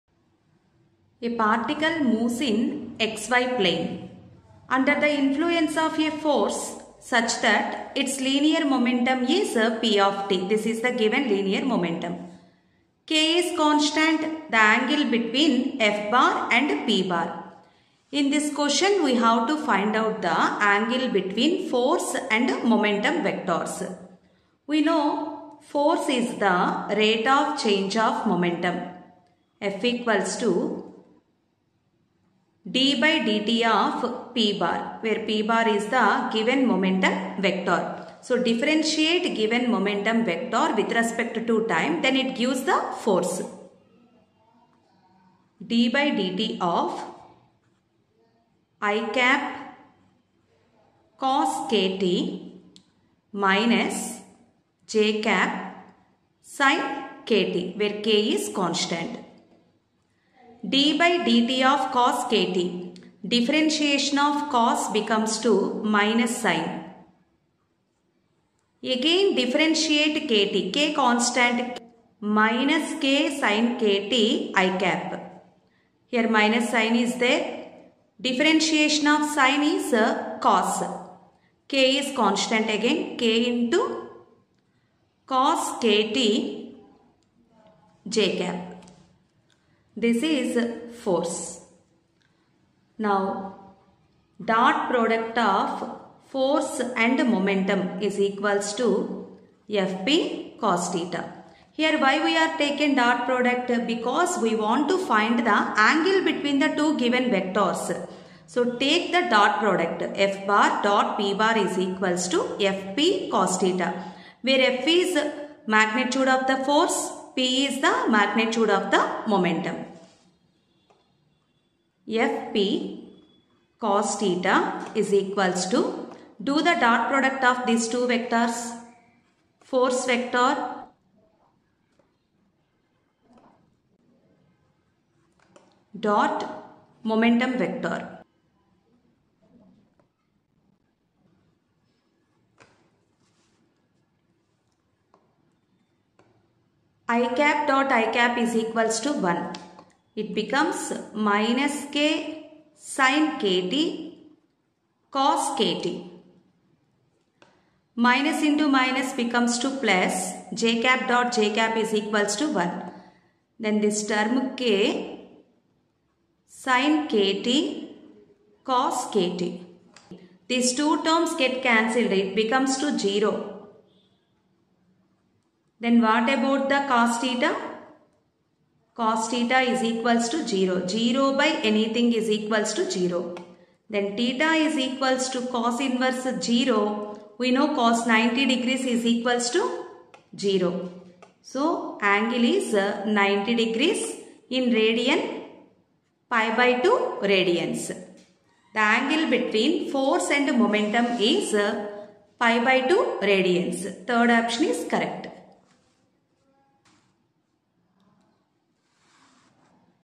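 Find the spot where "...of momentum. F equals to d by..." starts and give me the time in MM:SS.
00:27.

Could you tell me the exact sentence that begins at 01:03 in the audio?
Differentiation of cos becomes to minus sign.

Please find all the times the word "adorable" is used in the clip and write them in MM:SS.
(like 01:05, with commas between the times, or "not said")
not said.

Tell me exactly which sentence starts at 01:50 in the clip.
F bar dot P bar is equals to Fp cos theta.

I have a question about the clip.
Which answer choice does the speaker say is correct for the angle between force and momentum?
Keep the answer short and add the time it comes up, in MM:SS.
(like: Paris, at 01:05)
Third option, at 03:24.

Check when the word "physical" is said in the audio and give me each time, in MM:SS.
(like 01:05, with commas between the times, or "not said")
not said.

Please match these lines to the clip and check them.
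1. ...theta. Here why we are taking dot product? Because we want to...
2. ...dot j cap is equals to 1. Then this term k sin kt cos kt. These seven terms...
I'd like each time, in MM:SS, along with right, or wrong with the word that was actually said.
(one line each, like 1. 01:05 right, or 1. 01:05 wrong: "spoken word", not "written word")
1. 01:40 right
2. 02:41 wrong: "two", not "seven".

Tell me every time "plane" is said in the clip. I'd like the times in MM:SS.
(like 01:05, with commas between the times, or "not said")
00:03.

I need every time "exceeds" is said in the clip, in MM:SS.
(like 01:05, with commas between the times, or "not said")
not said.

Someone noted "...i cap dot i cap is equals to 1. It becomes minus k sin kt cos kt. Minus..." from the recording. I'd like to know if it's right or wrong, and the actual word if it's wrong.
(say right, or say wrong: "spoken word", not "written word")
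right.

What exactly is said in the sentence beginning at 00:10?
This is the given linear momentum.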